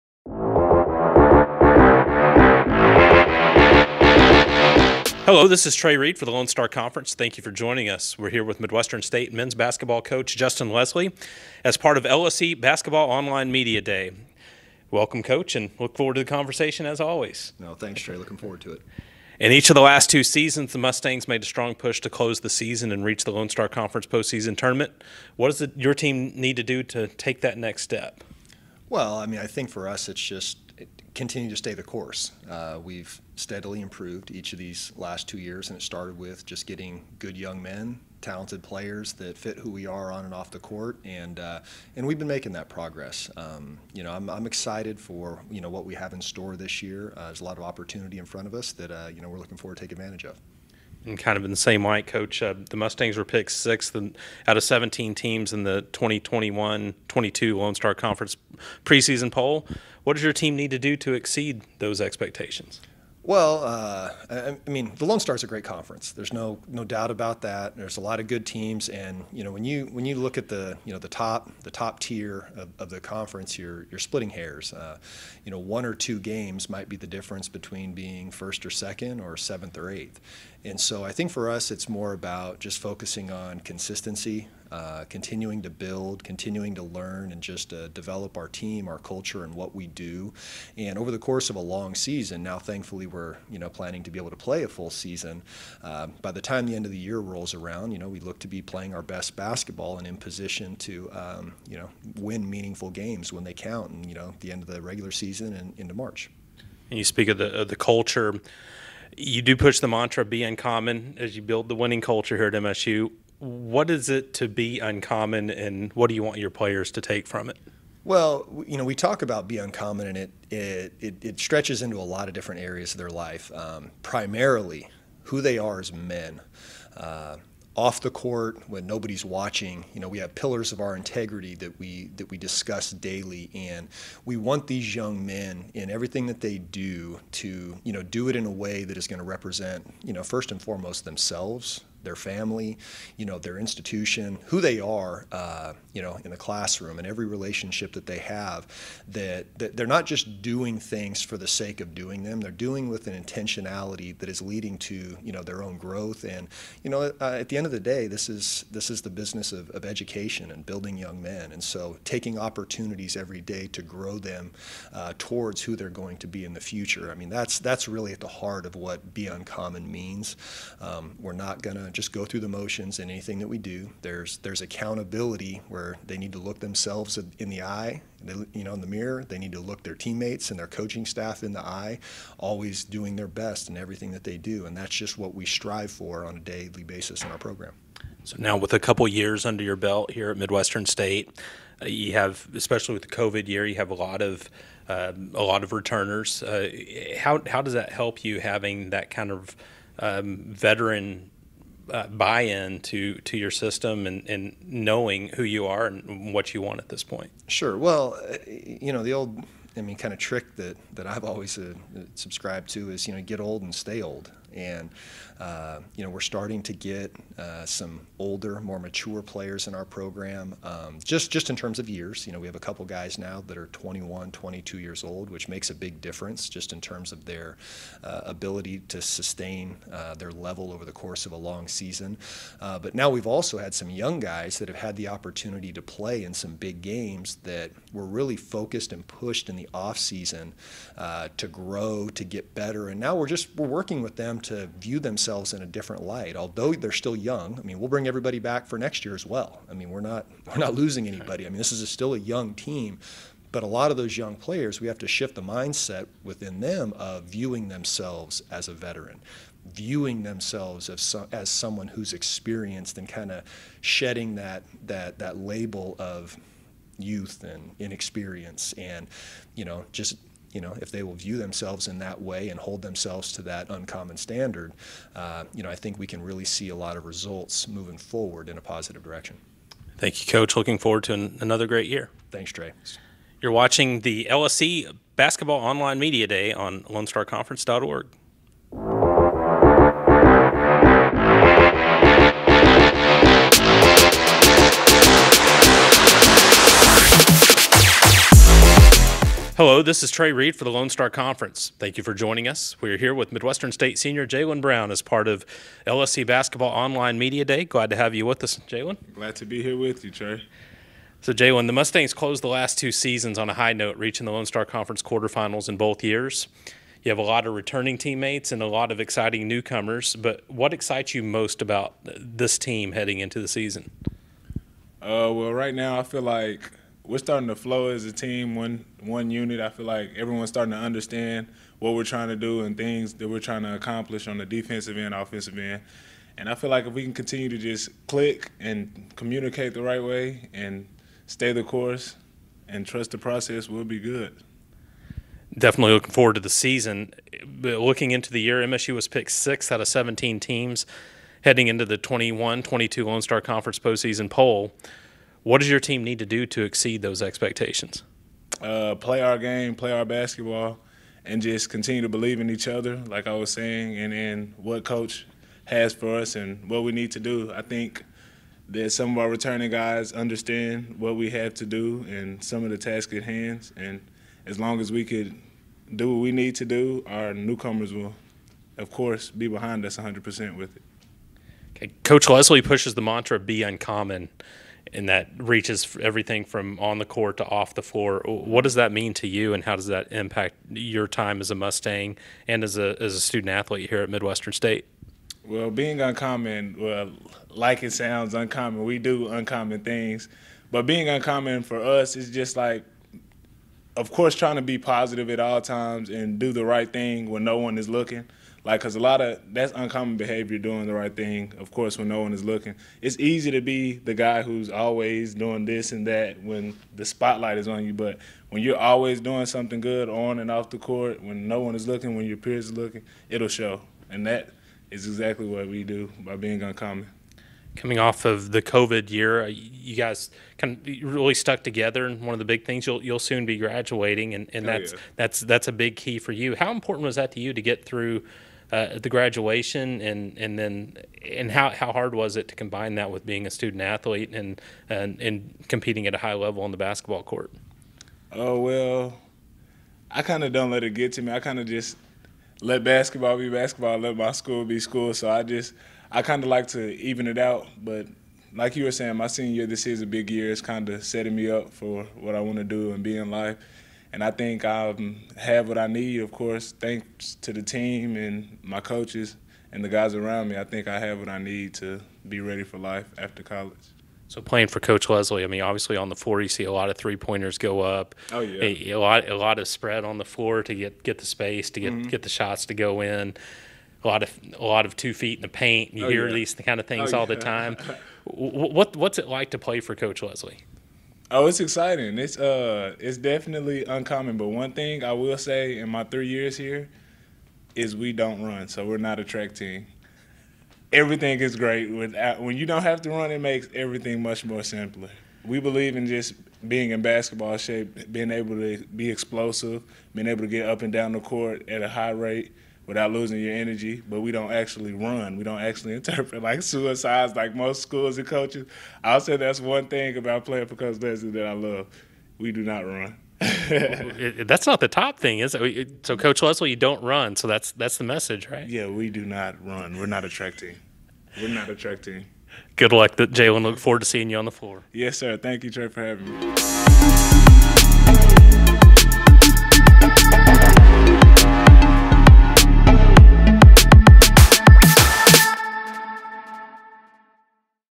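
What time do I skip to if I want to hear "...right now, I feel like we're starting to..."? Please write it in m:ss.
5:25.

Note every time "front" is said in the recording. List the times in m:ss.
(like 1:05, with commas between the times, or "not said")
0:48.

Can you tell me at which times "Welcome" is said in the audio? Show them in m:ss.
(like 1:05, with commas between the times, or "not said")
0:14.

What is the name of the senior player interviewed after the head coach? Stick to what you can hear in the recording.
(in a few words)
Jalen Brown.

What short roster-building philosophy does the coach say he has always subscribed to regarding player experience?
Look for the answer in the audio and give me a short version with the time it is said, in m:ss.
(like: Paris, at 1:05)
Get old and stay old, at 3:33.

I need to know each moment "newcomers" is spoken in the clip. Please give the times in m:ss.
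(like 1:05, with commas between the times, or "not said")
5:19, 6:17.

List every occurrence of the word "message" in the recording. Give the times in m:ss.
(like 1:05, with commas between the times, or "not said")
8:48.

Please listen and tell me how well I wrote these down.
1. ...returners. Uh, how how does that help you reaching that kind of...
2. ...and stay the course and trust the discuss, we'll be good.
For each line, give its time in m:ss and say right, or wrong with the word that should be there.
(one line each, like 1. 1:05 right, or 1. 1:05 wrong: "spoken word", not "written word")
1. 3:15 wrong: "having", not "reaching"
2. 5:40 wrong: "process", not "discuss".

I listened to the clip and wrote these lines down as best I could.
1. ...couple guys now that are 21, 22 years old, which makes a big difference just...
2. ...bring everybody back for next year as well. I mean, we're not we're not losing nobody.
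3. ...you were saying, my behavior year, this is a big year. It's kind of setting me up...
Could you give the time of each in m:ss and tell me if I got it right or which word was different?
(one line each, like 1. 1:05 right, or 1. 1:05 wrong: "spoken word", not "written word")
1. 3:42 right
2. 4:07 wrong: "anybody", not "nobody"
3. 7:38 wrong: "senior", not "behavior".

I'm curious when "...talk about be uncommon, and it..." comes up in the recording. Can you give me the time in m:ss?
1:58.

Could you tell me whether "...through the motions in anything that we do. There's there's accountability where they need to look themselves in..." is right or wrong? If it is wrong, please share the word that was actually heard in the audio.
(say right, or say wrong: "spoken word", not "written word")
right.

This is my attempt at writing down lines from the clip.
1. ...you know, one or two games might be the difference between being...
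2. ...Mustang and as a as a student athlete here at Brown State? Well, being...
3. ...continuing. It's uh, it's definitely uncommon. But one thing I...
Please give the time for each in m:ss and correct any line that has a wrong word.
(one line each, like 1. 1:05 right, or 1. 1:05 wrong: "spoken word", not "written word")
1. 1:15 right
2. 6:31 wrong: "Midwestern", not "Brown"
3. 8:11 wrong: "exciting", not "continuing".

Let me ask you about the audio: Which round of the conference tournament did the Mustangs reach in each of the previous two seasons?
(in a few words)
quarterfinals.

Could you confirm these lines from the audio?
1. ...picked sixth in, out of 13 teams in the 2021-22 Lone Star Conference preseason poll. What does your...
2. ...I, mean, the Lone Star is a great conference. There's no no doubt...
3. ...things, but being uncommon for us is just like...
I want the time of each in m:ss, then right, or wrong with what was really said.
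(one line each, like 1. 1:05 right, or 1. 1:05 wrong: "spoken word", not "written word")
1. 0:53 wrong: "17", not "13"
2. 1:04 right
3. 6:39 right.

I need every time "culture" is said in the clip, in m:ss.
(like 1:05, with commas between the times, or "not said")
1:28, 1:47, 1:52.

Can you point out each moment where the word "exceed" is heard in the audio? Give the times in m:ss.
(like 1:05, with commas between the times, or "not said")
1:01, 5:56.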